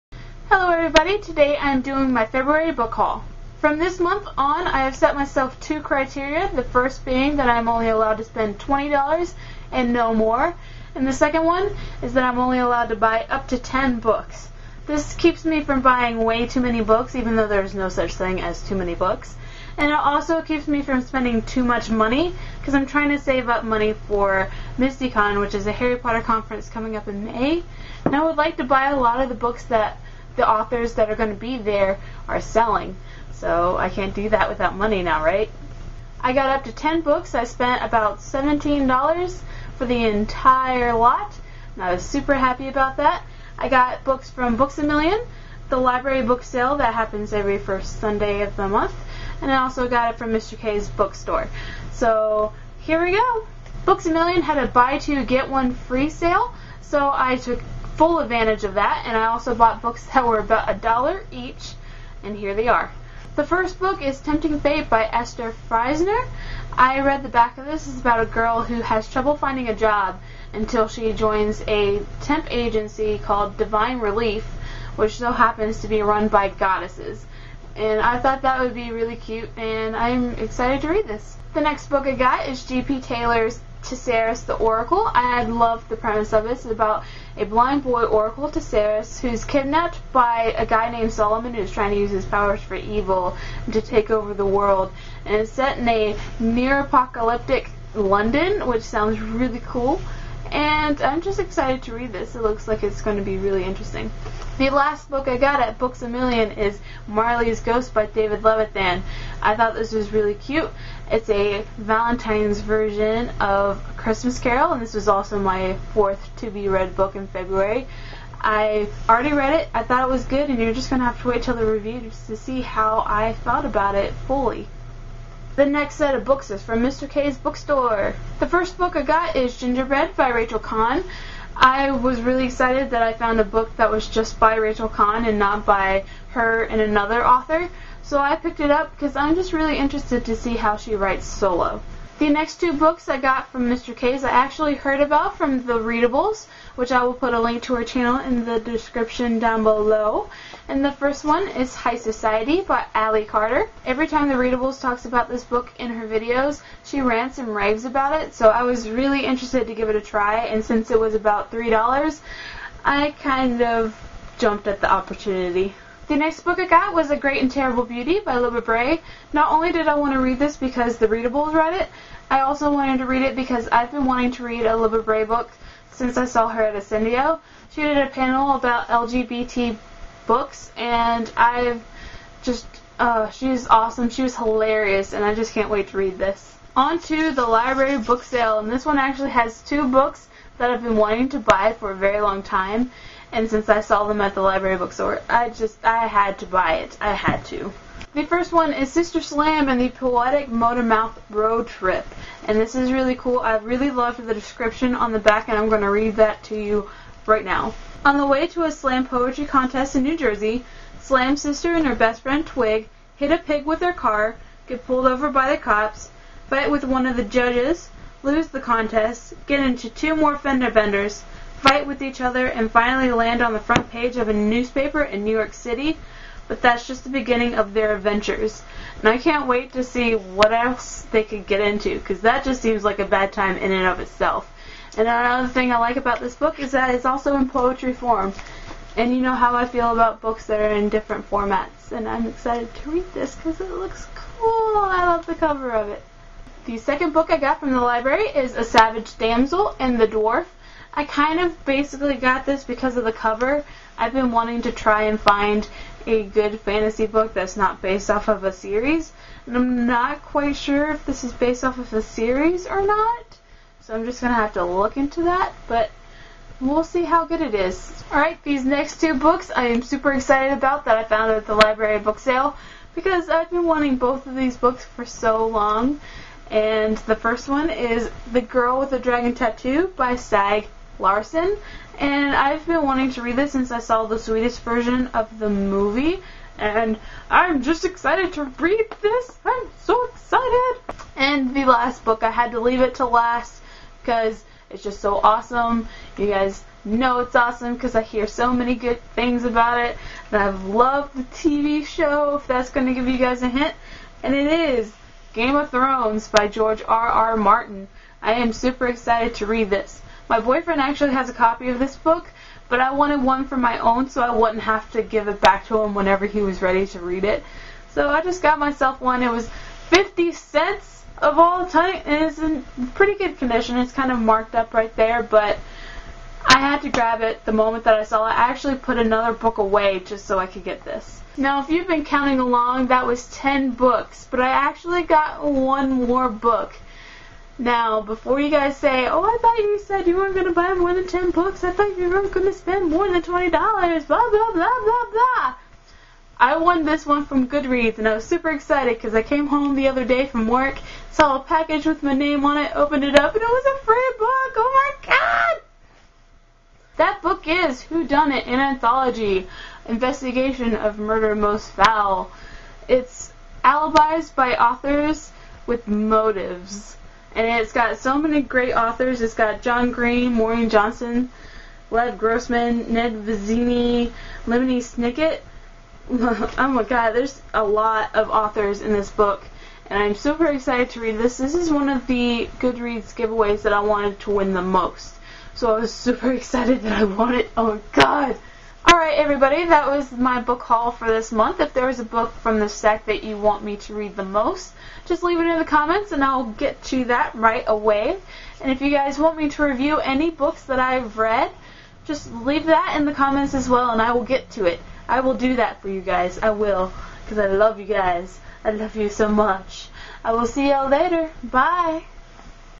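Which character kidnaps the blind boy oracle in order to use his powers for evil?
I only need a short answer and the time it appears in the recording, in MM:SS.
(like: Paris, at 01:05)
Solomon, at 01:31.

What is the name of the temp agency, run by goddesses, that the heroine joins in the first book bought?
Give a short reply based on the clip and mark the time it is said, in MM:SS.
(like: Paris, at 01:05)
Divine Relief, at 01:13.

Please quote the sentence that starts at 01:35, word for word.
And it's set in a near apocalyptic London, which sounds really cool.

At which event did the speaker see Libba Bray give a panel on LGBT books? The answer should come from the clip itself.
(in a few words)
Ascendio.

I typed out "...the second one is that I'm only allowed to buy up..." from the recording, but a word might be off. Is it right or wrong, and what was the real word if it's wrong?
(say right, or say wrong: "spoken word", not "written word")
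right.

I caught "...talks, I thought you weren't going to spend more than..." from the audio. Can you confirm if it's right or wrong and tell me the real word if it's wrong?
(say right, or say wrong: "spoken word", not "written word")
wrong: "books", not "talks".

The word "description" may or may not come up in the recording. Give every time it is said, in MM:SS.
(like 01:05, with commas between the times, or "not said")
02:28, 03:24.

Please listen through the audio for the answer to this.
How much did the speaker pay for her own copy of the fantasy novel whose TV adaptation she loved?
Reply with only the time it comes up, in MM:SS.
05:19.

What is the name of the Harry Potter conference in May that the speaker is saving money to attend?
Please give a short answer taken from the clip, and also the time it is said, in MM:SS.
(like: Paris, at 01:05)
MystiCon, at 00:24.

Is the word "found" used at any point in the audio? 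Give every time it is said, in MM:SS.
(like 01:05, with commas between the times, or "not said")
02:13, 04:31.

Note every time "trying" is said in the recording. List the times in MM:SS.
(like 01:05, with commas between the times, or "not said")
00:22, 01:31.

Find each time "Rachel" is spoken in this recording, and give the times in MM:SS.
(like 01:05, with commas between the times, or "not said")
02:10, 02:14.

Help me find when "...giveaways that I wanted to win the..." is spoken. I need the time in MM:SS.
06:23.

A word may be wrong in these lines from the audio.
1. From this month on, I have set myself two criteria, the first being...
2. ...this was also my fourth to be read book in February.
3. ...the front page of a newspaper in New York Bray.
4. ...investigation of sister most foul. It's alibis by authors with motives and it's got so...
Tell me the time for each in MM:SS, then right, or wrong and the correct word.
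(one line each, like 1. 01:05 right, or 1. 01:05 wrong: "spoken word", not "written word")
1. 00:03 right
2. 01:54 right
3. 03:43 wrong: "City", not "Bray"
4. 05:59 wrong: "murder", not "sister".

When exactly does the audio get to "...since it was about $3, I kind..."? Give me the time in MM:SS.
02:40.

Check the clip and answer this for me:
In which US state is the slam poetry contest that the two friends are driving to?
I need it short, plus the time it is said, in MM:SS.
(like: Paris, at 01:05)
New Jersey, at 03:30.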